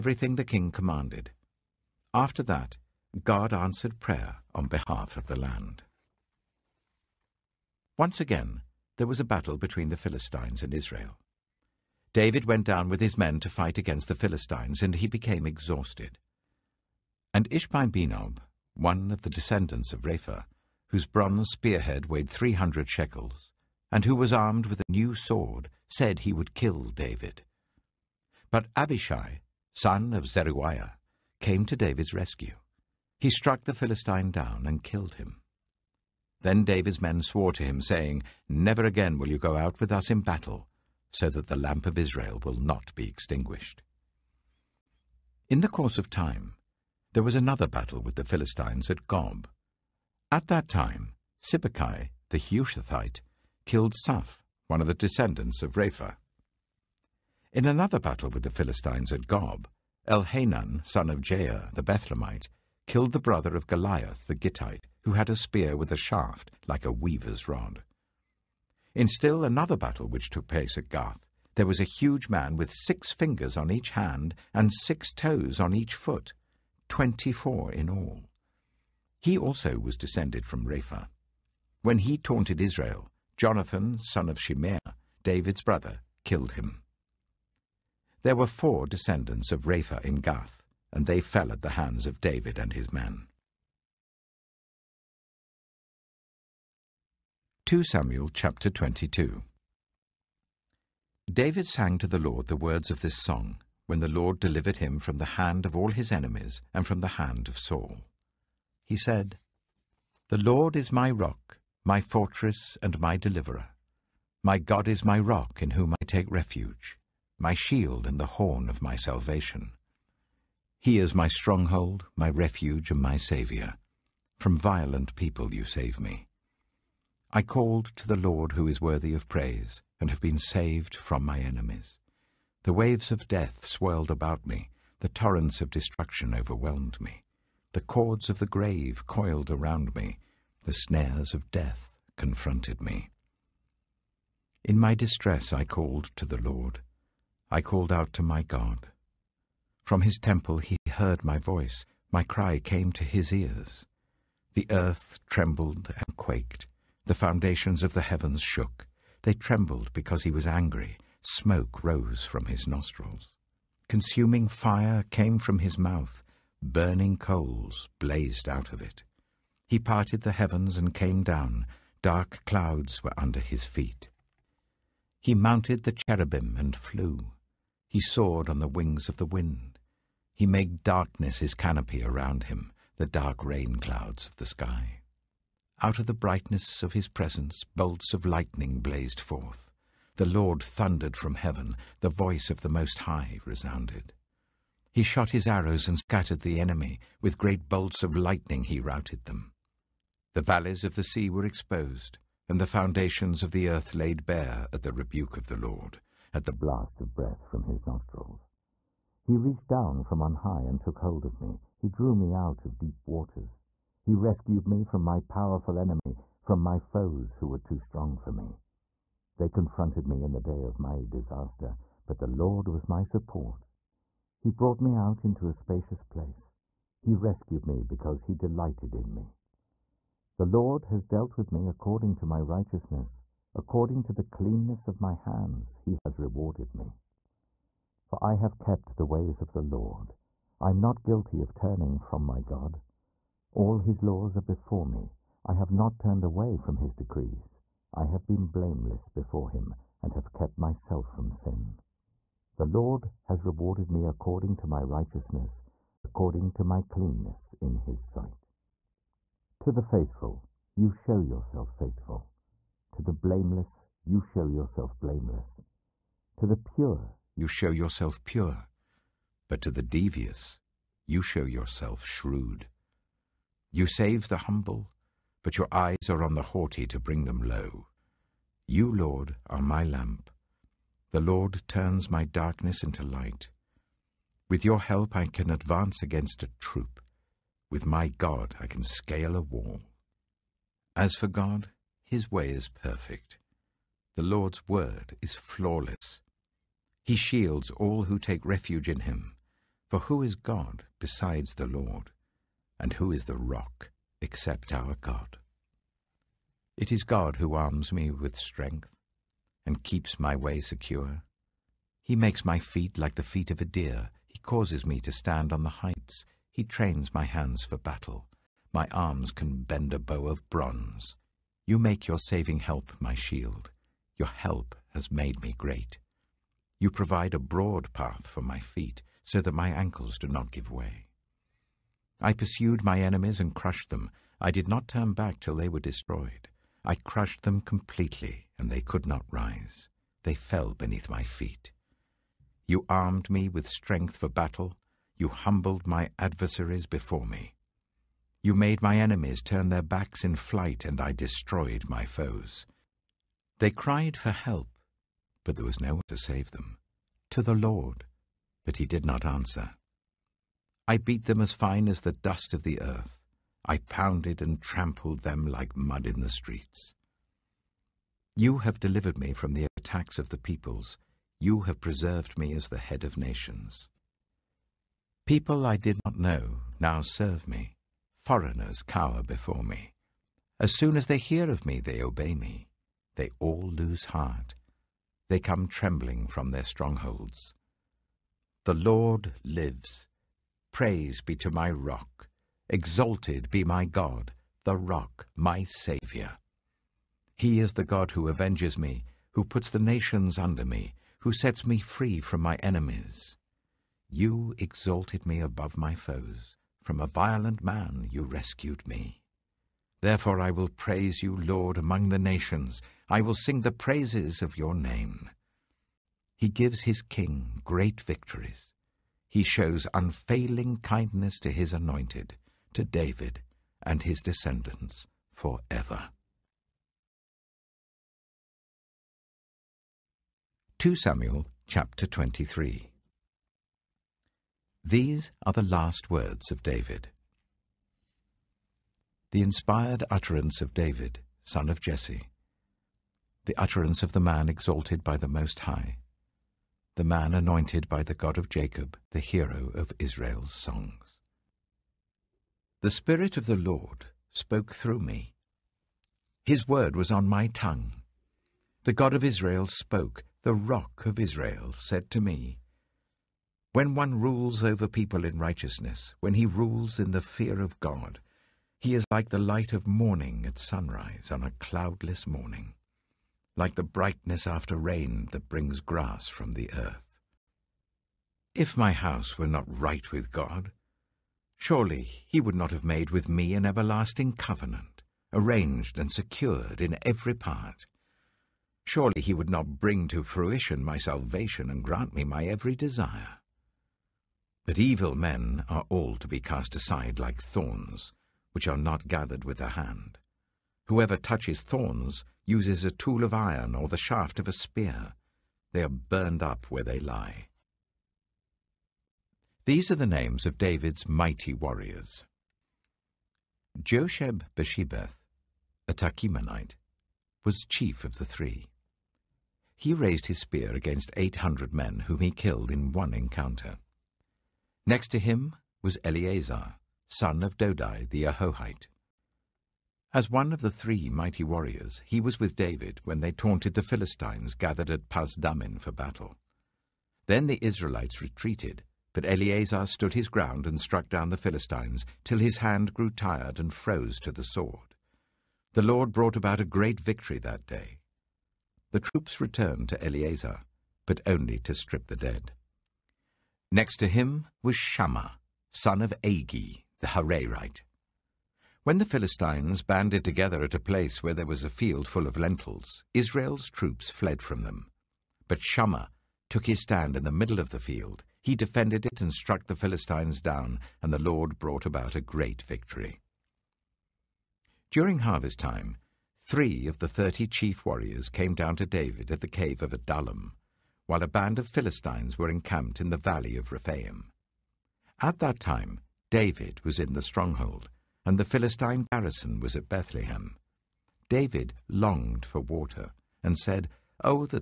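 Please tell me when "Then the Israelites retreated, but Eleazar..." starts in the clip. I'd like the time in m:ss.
8:57.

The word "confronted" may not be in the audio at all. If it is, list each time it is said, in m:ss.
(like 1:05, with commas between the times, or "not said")
2:22, 3:39.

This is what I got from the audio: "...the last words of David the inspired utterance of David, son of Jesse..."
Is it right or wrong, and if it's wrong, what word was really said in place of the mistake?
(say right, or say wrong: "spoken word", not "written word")
right.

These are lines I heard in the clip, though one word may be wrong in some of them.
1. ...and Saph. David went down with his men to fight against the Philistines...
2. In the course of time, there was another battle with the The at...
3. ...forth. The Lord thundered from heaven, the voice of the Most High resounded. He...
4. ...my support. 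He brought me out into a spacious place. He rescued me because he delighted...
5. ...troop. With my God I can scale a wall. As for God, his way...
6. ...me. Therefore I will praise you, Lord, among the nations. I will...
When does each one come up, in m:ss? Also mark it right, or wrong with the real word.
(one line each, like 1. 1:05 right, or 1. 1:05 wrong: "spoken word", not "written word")
1. 0:10 wrong: "Israel", not "Saph"
2. 0:45 wrong: "Philistines", not "The"
3. 3:09 right
4. 3:42 right
5. 4:46 right
6. 6:48 right.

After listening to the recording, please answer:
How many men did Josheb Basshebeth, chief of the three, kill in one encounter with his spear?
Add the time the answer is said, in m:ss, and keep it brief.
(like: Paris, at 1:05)
800, at 8:41.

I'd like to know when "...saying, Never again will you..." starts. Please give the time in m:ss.
0:37.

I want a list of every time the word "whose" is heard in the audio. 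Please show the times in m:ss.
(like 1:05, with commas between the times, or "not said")
0:20.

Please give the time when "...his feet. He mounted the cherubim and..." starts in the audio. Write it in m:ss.
2:53.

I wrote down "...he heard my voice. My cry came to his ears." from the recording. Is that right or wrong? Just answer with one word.
right.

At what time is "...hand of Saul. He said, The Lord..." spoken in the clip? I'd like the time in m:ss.
1:47.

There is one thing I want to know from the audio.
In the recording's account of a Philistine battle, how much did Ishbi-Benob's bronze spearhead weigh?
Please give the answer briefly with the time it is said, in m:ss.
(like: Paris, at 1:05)
300 shekels, at 0:22.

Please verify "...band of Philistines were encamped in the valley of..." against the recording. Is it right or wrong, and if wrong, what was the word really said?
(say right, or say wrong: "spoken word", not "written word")
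right.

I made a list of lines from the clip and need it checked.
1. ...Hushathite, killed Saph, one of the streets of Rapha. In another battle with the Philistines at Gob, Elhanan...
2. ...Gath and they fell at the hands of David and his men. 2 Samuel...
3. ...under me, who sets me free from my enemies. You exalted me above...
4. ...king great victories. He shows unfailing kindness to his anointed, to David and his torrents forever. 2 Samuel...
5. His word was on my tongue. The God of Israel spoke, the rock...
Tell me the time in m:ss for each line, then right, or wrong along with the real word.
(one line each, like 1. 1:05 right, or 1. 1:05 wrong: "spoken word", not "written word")
1. 0:52 wrong: "descendants", not "streets"
2. 1:30 right
3. 6:40 right
4. 6:57 wrong: "descendants", not "torrents"
5. 7:36 right.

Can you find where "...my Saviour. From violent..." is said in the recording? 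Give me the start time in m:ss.
2:03.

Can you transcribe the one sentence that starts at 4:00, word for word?
I am not guilty of turning from my God.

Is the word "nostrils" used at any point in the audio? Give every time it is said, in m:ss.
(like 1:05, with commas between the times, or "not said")
2:42, 3:27.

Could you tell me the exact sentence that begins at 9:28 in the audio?
He defended it and struck the Philistines down, and the Lord brought about a great victory.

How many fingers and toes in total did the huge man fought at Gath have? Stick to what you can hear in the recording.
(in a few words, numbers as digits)
24.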